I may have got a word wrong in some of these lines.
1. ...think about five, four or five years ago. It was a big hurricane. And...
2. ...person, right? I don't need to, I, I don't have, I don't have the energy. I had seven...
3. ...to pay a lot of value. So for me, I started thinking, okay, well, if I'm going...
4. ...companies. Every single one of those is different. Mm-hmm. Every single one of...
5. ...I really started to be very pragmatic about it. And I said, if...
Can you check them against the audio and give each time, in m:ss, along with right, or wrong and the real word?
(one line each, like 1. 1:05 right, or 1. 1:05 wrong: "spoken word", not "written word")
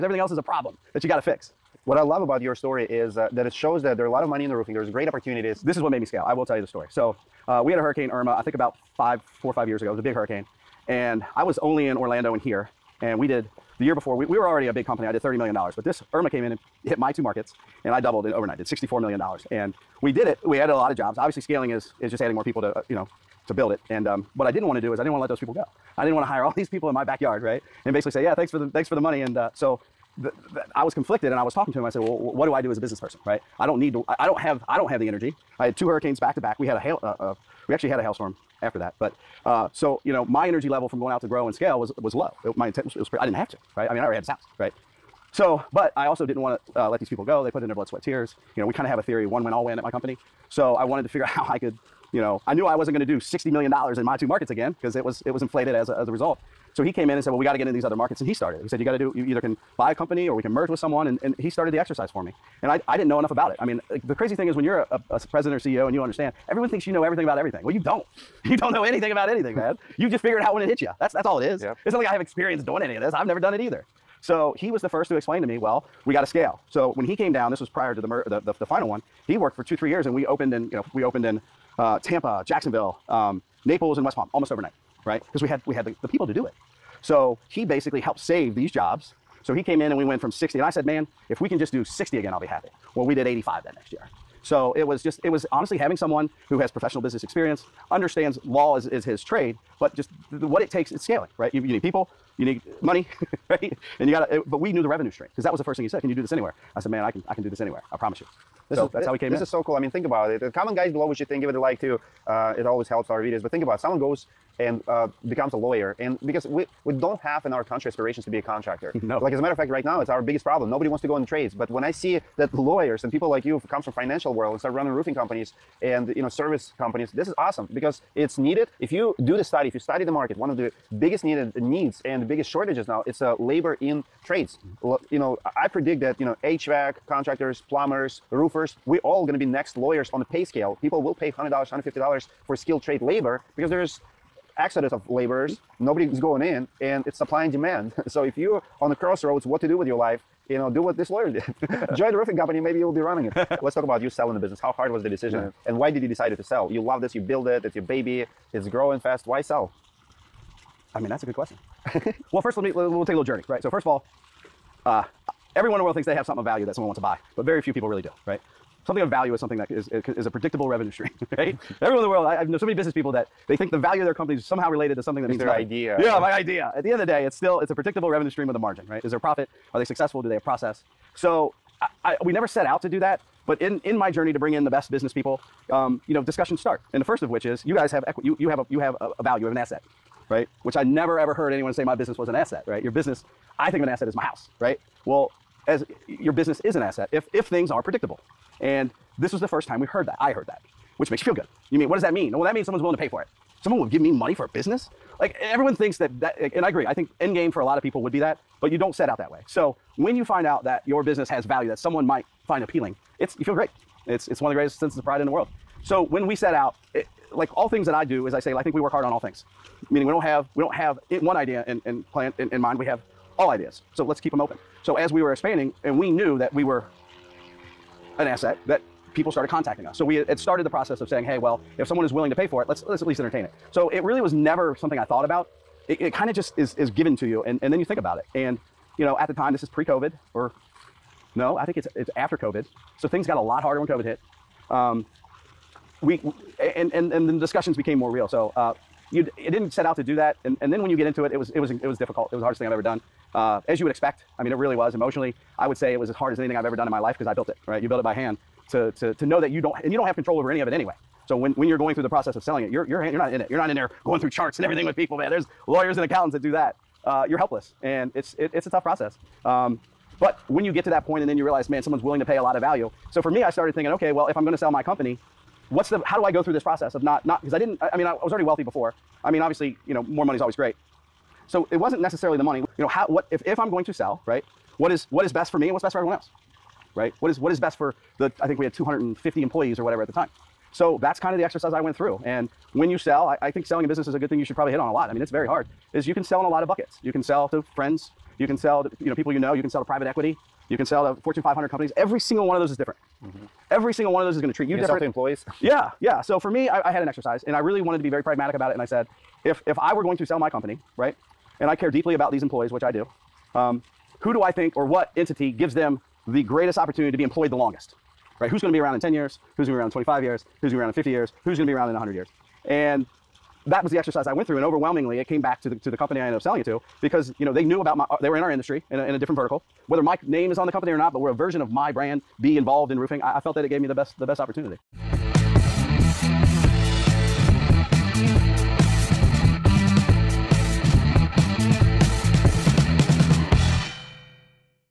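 1. 0:08 right
2. 0:32 wrong: "two", not "seven"
3. 4:32 right
4. 5:01 right
5. 5:07 wrong: "wanted", not "started".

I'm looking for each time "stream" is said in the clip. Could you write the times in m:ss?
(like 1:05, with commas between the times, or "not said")
1:45, 2:50, 2:58.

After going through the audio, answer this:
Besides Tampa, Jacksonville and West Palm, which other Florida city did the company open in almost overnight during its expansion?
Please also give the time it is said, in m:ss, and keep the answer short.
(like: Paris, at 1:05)
Naples, at 1:23.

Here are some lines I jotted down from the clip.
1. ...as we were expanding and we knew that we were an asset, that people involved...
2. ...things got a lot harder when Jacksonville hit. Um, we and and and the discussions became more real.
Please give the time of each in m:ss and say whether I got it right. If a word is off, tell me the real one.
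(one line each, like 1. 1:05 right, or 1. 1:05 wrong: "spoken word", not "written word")
1. 3:44 wrong: "started", not "involved"
2. 4:03 wrong: "COVID", not "Jacksonville".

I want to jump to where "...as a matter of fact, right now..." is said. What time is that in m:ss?
1:59.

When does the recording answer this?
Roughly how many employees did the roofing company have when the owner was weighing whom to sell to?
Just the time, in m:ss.
4:48.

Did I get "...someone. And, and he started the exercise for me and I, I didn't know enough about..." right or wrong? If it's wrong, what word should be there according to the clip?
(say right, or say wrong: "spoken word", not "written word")
right.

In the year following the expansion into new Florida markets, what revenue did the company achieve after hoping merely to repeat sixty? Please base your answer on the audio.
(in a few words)
85.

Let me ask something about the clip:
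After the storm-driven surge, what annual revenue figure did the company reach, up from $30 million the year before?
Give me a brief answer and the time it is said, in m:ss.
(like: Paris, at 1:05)
$64 million, at 0:18.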